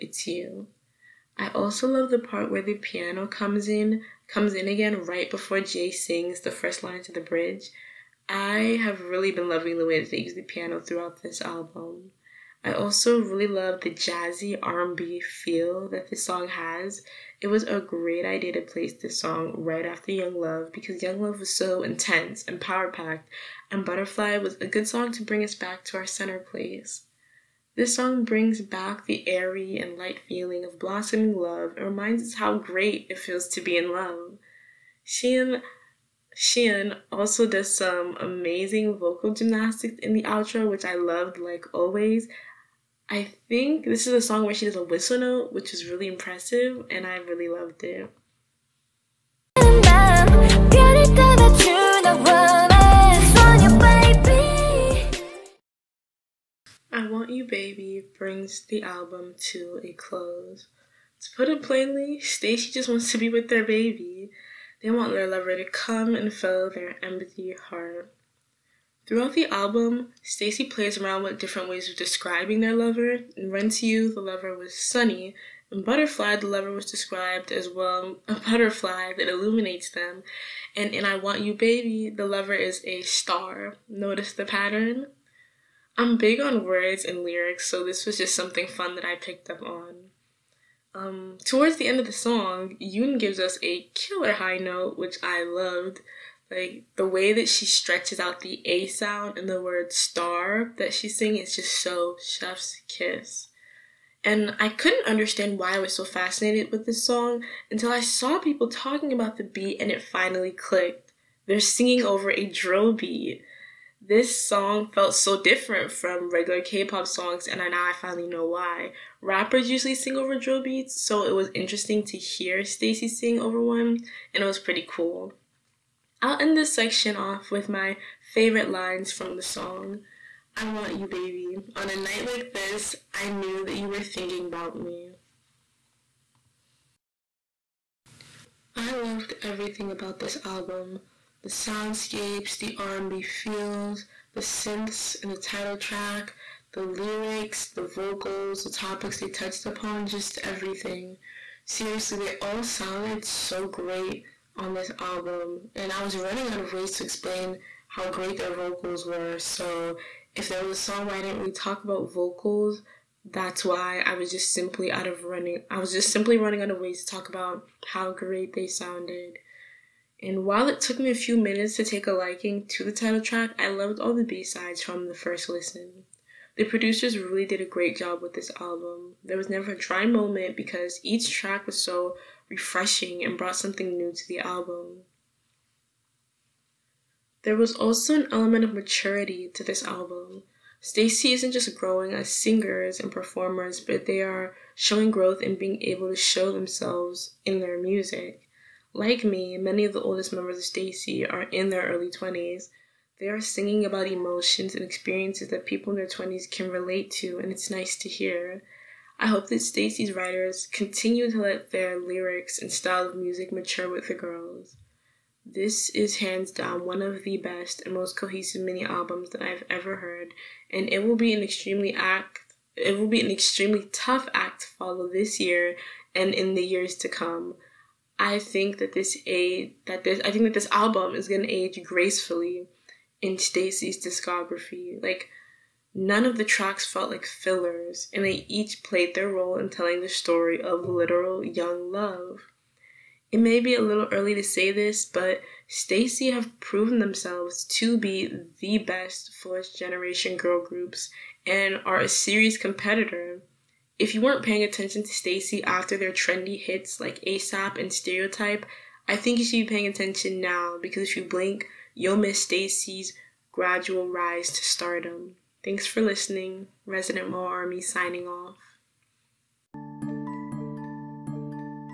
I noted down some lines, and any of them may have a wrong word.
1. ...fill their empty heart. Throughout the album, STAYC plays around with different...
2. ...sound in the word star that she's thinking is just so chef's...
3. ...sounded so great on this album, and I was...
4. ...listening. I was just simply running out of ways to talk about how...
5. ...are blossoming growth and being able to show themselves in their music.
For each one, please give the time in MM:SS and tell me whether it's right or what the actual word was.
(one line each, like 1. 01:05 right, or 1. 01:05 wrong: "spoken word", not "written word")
1. 01:06 right
2. 01:38 wrong: "singing", not "thinking"
3. 02:32 right
4. 02:45 wrong: "running", not "listening"
5. 03:14 wrong: "showing", not "blossoming".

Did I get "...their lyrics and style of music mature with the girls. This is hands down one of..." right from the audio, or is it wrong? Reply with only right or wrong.
right.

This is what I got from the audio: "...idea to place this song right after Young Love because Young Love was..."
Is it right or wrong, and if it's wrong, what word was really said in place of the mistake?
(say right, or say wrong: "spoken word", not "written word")
right.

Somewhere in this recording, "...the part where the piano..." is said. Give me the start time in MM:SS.
00:02.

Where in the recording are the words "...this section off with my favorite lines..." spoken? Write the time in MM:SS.
02:06.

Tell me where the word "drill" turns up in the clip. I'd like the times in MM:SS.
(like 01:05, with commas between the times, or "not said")
01:52, 02:00.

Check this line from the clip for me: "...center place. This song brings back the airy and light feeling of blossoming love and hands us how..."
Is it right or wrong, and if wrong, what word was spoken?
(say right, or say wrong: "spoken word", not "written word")
wrong: "reminds", not "hands".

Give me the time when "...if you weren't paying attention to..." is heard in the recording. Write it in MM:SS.
04:14.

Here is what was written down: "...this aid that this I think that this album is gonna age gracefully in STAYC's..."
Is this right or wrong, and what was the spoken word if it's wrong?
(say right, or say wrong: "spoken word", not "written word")
right.